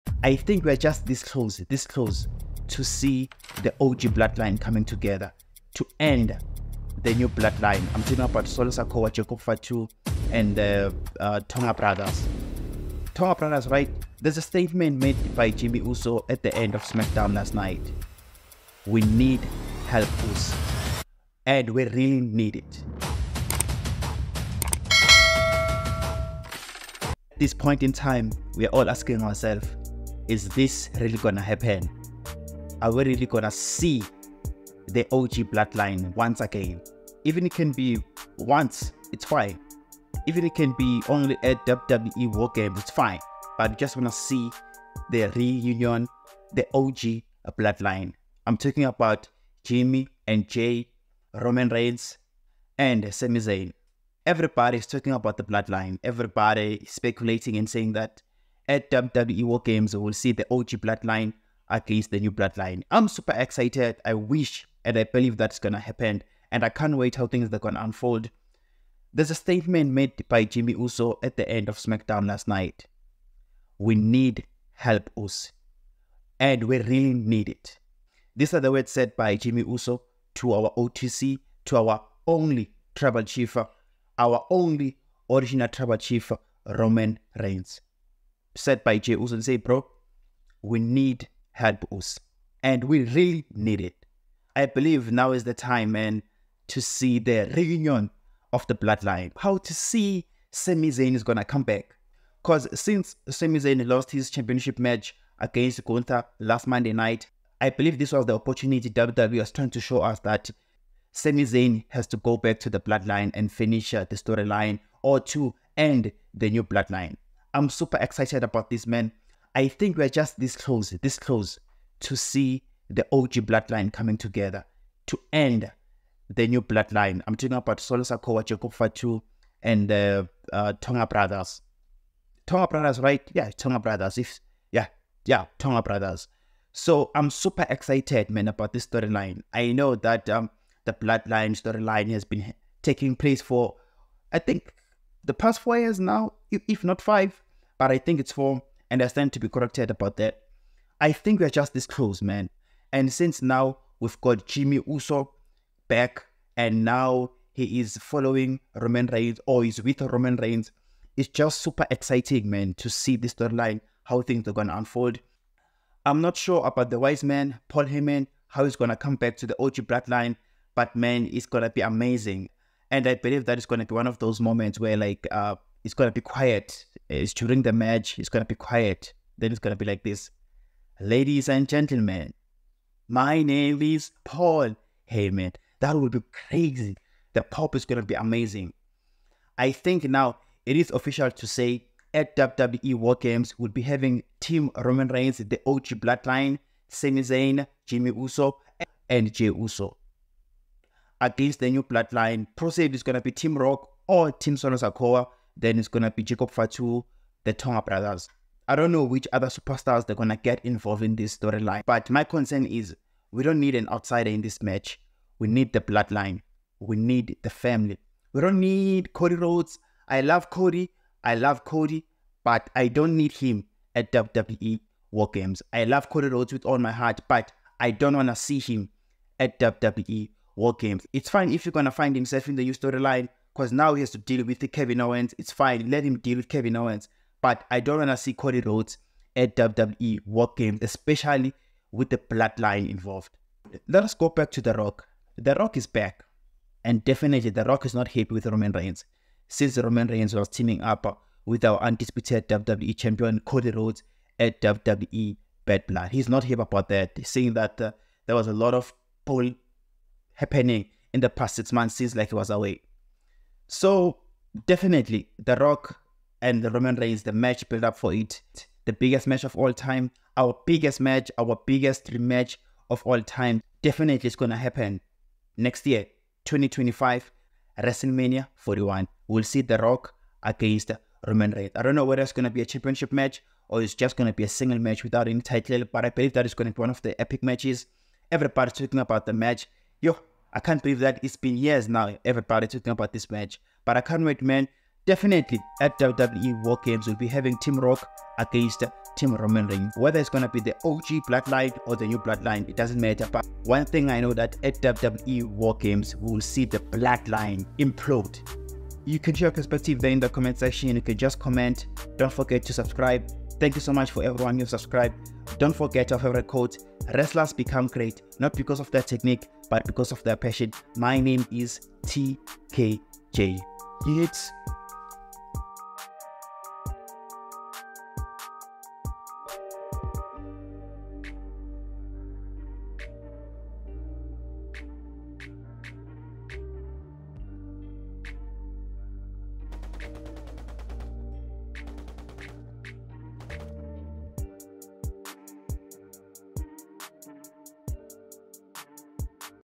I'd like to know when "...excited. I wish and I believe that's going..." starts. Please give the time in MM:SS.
01:03.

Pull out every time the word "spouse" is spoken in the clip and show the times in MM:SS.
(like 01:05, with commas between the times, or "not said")
not said.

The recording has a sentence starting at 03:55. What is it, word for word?
It's fine, let him deal with Kevin Owens.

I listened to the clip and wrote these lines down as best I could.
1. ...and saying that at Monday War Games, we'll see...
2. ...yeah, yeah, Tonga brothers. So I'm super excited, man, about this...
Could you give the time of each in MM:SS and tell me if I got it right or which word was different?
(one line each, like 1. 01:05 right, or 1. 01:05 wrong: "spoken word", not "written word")
1. 00:57 wrong: "WWE", not "Monday"
2. 02:14 right.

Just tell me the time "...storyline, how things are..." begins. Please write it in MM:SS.
02:43.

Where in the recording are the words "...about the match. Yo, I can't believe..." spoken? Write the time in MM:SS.
04:48.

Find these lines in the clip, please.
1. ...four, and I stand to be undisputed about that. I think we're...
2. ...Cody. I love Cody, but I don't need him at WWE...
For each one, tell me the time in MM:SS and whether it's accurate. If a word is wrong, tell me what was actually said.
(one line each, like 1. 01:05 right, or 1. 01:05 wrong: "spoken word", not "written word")
1. 02:28 wrong: "corrected", not "undisputed"
2. 03:40 right.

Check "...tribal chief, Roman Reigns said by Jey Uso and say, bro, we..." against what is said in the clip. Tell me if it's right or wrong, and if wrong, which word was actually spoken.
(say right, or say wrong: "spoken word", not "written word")
right.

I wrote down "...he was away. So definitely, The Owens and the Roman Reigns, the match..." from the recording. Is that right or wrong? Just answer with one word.
wrong.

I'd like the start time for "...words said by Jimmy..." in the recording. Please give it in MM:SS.
01:18.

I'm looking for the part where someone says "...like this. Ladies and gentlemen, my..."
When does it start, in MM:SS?
02:59.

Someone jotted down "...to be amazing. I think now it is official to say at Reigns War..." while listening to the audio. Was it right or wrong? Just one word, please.
wrong.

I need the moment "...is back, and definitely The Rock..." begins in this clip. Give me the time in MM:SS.
04:05.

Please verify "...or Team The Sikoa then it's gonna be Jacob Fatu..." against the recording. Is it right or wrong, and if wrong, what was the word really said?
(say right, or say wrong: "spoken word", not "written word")
wrong: "Solo", not "The".